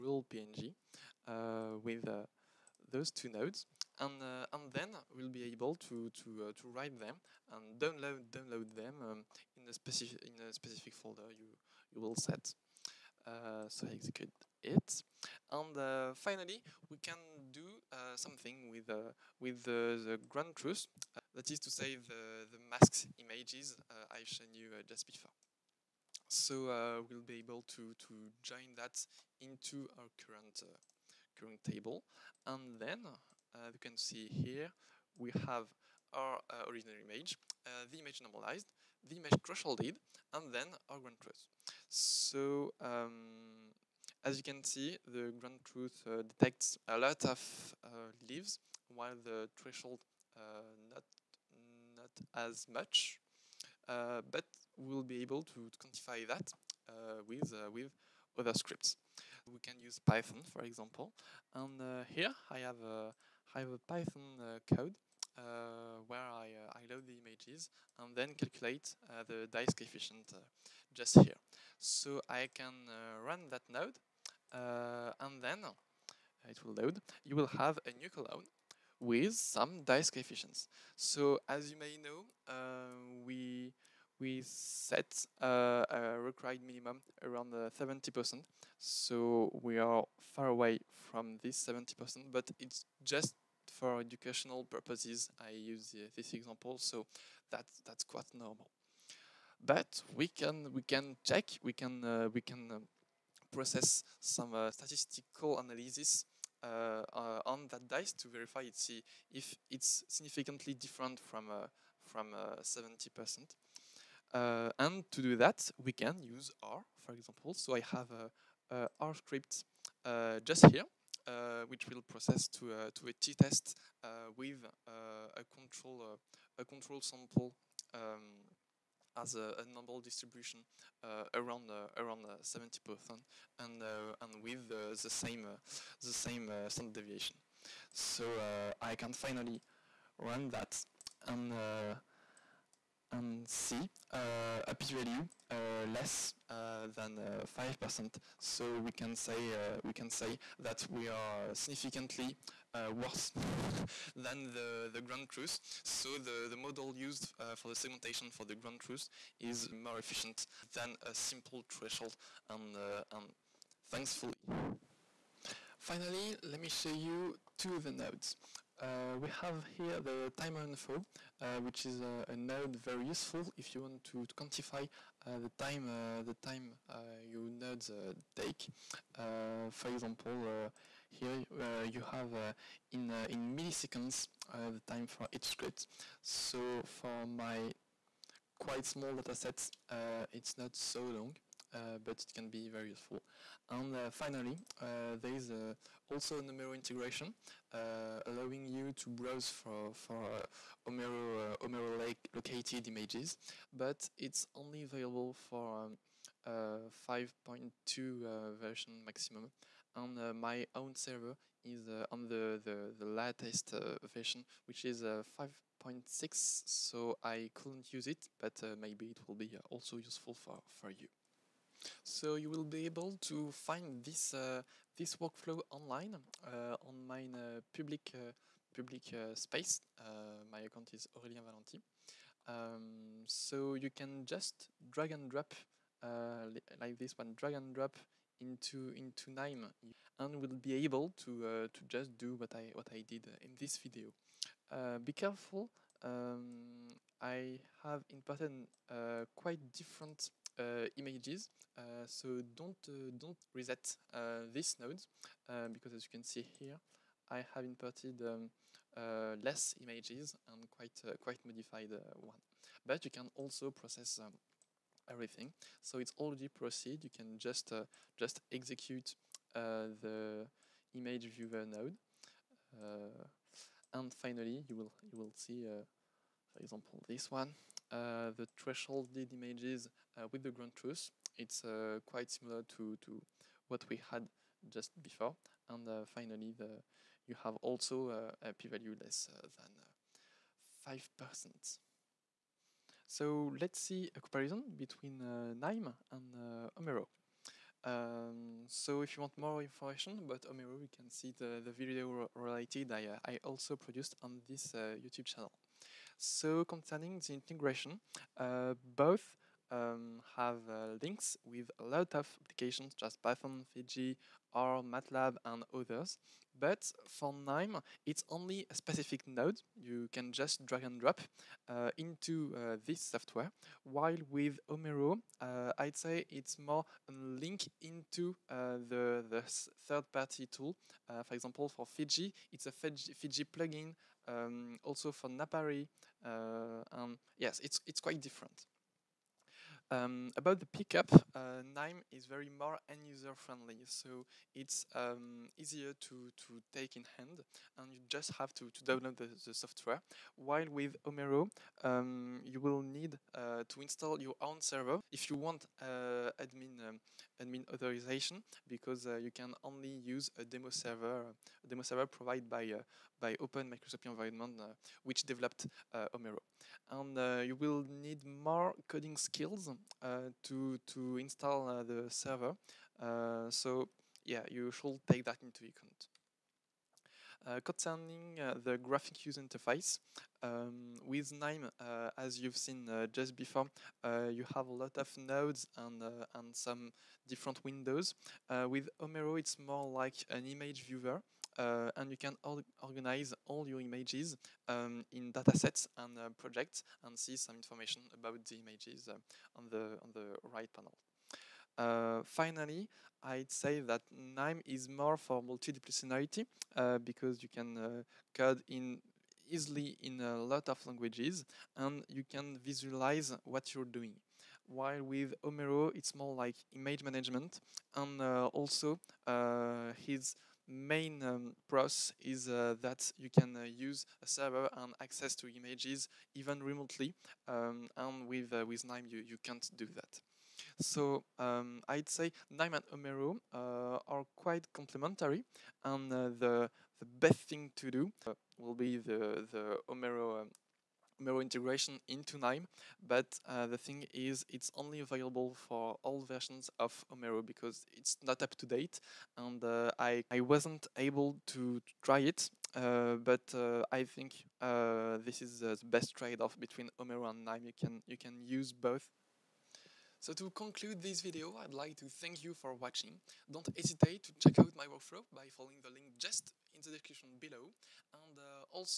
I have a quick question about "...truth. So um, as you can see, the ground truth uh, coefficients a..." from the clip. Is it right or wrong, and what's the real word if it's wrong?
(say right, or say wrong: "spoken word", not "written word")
wrong: "detects", not "coefficients".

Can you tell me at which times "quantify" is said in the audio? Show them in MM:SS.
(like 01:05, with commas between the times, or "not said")
00:55, 02:54.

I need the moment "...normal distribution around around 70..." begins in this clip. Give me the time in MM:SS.
02:09.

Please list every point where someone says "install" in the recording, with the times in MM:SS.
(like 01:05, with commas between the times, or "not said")
05:53, 06:11.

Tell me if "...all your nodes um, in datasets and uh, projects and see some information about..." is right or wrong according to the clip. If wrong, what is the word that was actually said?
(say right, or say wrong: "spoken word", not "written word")
wrong: "images", not "nodes".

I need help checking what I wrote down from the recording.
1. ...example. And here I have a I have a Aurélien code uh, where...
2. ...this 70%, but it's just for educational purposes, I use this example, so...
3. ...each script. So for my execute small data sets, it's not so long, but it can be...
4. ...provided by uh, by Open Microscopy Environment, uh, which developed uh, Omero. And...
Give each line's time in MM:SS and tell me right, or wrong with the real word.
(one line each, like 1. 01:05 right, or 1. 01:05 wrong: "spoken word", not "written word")
1. 01:00 wrong: "Python", not "Aurélien"
2. 01:31 right
3. 03:05 wrong: "quite", not "execute"
4. 06:02 right.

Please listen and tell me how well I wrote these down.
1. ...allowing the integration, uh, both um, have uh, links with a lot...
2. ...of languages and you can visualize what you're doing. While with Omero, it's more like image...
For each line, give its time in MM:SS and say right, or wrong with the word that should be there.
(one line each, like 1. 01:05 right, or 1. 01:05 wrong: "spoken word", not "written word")
1. 05:06 wrong: "concerning", not "allowing"
2. 06:50 right.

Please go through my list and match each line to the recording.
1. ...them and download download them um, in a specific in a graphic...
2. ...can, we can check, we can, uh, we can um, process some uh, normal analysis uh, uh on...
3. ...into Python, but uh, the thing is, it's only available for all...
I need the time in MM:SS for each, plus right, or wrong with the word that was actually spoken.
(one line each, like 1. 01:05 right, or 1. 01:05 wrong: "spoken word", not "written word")
1. 00:06 wrong: "specific", not "graphic"
2. 01:40 wrong: "statistical", not "normal"
3. 07:22 wrong: "Knime", not "Python".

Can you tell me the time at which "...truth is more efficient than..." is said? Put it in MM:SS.
02:38.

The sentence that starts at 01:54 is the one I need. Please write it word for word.
Uh, and to do that, we can use R, for example.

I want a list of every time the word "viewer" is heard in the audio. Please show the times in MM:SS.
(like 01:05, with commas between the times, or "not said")
04:31, 06:30.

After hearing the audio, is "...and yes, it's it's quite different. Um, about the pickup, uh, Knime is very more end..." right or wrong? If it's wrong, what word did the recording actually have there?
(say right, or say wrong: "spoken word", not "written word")
right.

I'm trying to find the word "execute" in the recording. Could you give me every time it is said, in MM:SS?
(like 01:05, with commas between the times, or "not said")
00:13, 04:28.